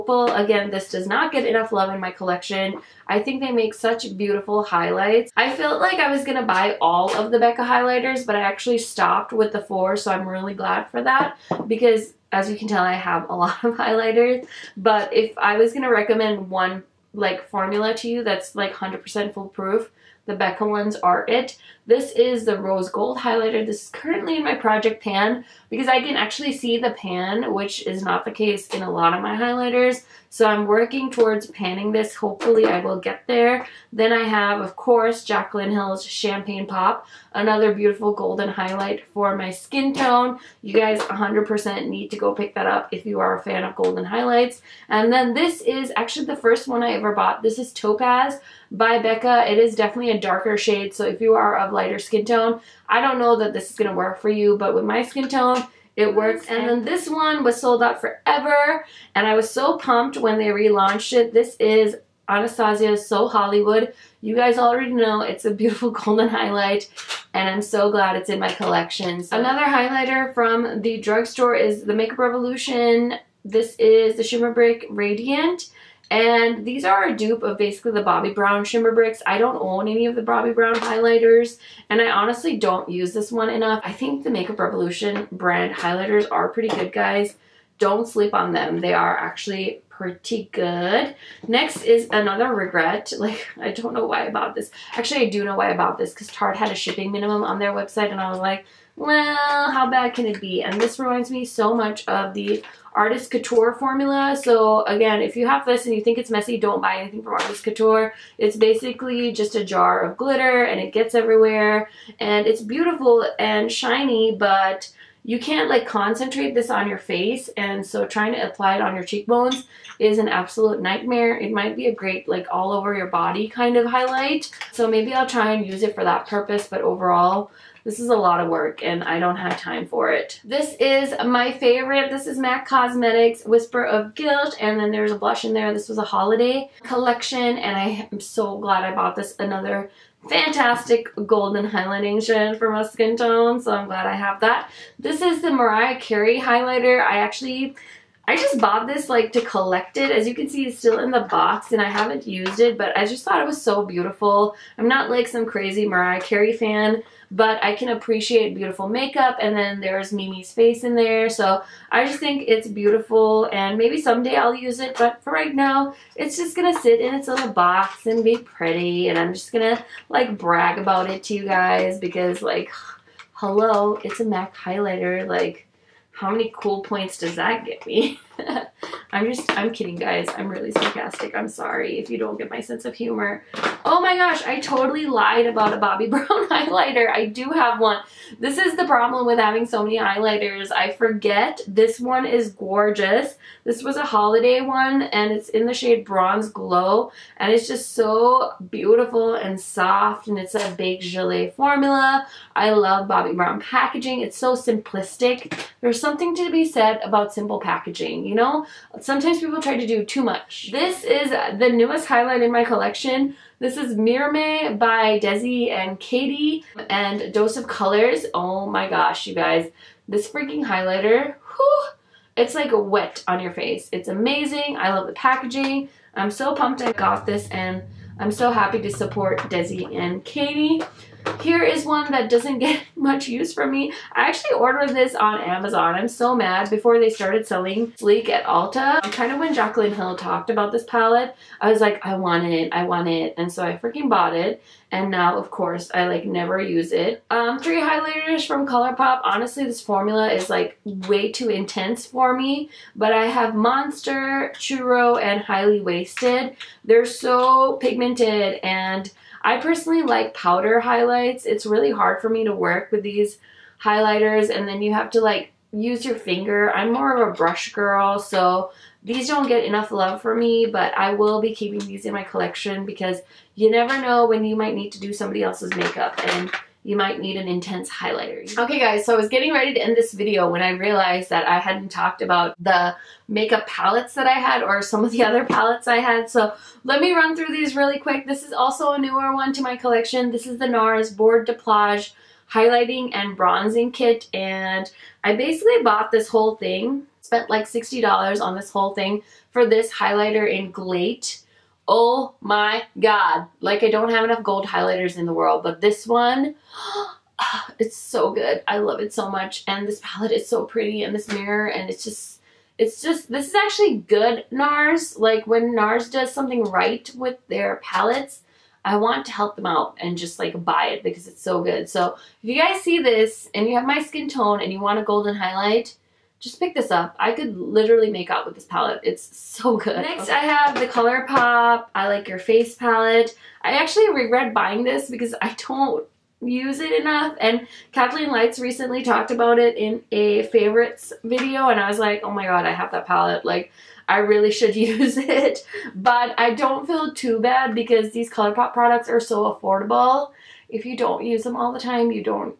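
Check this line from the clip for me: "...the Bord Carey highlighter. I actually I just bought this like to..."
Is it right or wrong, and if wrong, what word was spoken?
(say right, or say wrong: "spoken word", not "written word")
wrong: "Mariah", not "Bord".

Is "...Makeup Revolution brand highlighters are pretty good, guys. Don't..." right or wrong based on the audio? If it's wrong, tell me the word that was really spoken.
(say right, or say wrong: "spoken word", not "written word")
right.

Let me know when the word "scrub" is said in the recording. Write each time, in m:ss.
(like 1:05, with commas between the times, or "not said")
not said.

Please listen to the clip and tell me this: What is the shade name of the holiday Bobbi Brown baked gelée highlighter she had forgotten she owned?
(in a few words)
Bronze Glow.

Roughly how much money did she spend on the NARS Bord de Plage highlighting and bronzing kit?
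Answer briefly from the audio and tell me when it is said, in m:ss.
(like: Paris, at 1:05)
$60, at 4:57.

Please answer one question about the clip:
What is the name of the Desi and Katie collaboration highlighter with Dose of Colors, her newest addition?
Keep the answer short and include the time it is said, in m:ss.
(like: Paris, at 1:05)
Mirame, at 3:33.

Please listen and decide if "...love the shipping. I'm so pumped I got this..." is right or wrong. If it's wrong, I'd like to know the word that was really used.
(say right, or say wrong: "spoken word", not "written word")
wrong: "packaging", not "shipping".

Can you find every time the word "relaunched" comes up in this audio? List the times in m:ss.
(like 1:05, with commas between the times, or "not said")
1:00.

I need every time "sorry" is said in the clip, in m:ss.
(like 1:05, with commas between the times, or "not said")
3:01.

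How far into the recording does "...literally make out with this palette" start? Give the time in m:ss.
5:27.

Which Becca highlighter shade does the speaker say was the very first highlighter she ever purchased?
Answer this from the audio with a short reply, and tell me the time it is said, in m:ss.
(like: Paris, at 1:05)
Topaz, at 0:47.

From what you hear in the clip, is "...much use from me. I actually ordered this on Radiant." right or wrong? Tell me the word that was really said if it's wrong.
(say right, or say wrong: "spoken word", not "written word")
wrong: "Amazon", not "Radiant".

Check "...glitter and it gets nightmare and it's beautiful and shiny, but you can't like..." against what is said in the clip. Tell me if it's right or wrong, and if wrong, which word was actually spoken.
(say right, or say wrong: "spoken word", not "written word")
wrong: "everywhere", not "nightmare".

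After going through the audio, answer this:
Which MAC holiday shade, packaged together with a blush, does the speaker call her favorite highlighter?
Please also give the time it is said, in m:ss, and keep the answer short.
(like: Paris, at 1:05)
Whisper of Guilt, at 2:13.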